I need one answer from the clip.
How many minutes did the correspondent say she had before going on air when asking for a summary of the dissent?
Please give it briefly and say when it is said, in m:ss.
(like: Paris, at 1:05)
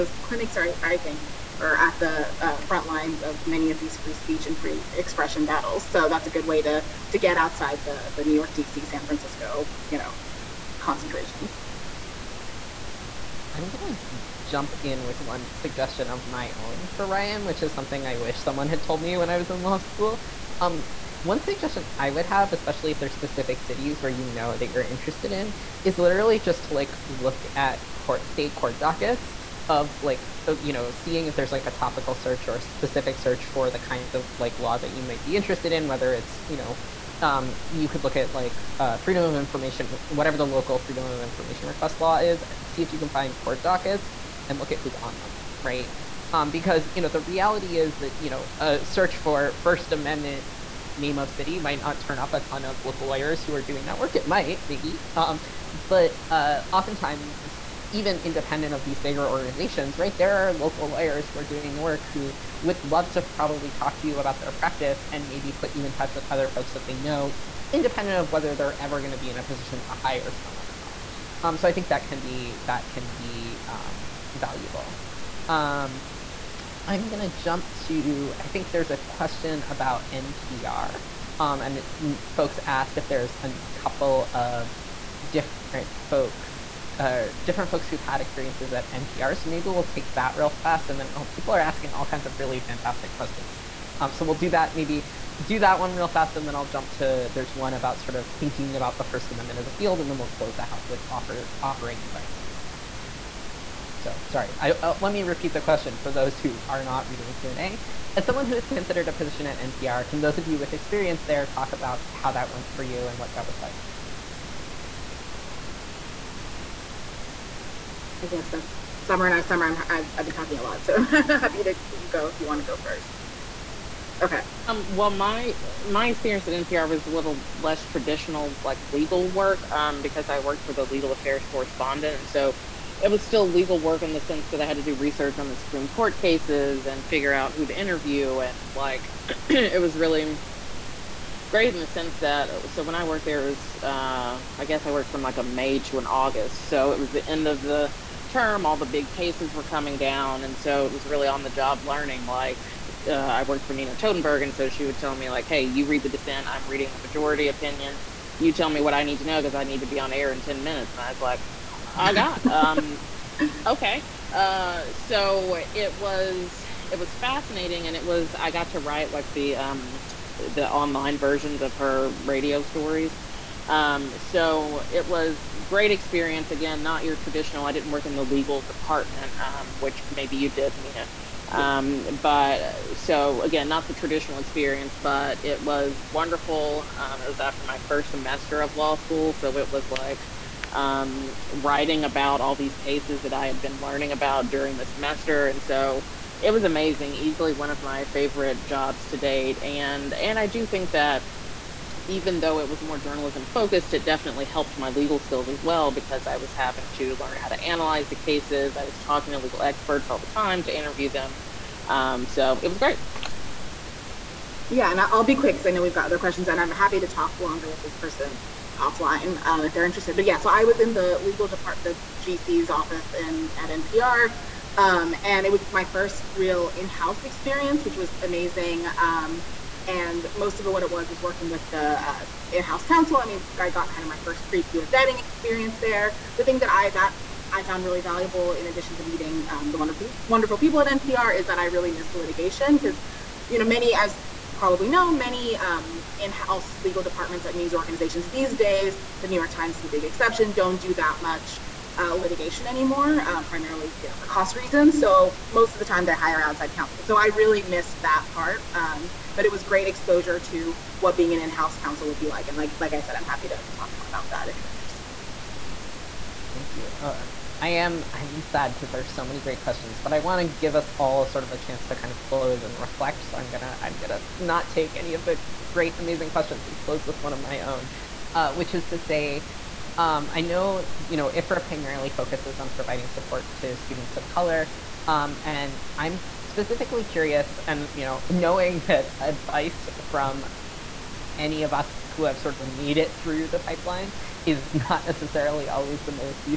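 10, at 2:40.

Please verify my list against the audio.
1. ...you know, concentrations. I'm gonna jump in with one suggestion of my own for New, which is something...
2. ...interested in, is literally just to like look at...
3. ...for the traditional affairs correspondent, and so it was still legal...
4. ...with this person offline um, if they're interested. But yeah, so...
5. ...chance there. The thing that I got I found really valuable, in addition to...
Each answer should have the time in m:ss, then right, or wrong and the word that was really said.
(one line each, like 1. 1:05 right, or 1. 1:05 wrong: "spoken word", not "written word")
1. 0:09 wrong: "Ryan", not "New"
2. 0:24 right
3. 2:10 wrong: "legal", not "traditional"
4. 3:37 right
5. 3:55 wrong: "experience", not "chance".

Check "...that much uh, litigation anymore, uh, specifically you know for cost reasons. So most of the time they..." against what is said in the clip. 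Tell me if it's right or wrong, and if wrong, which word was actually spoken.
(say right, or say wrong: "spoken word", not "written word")
wrong: "primarily", not "specifically".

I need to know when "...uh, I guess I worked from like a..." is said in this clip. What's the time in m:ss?
2:23.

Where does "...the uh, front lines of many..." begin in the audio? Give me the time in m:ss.
0:01.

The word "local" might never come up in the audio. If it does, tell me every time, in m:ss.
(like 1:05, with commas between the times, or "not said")
0:40, 0:52, 1:00.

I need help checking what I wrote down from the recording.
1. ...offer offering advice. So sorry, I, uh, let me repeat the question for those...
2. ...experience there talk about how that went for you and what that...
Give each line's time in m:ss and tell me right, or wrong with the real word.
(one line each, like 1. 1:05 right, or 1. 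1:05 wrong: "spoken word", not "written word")
1. 1:41 right
2. 1:50 right.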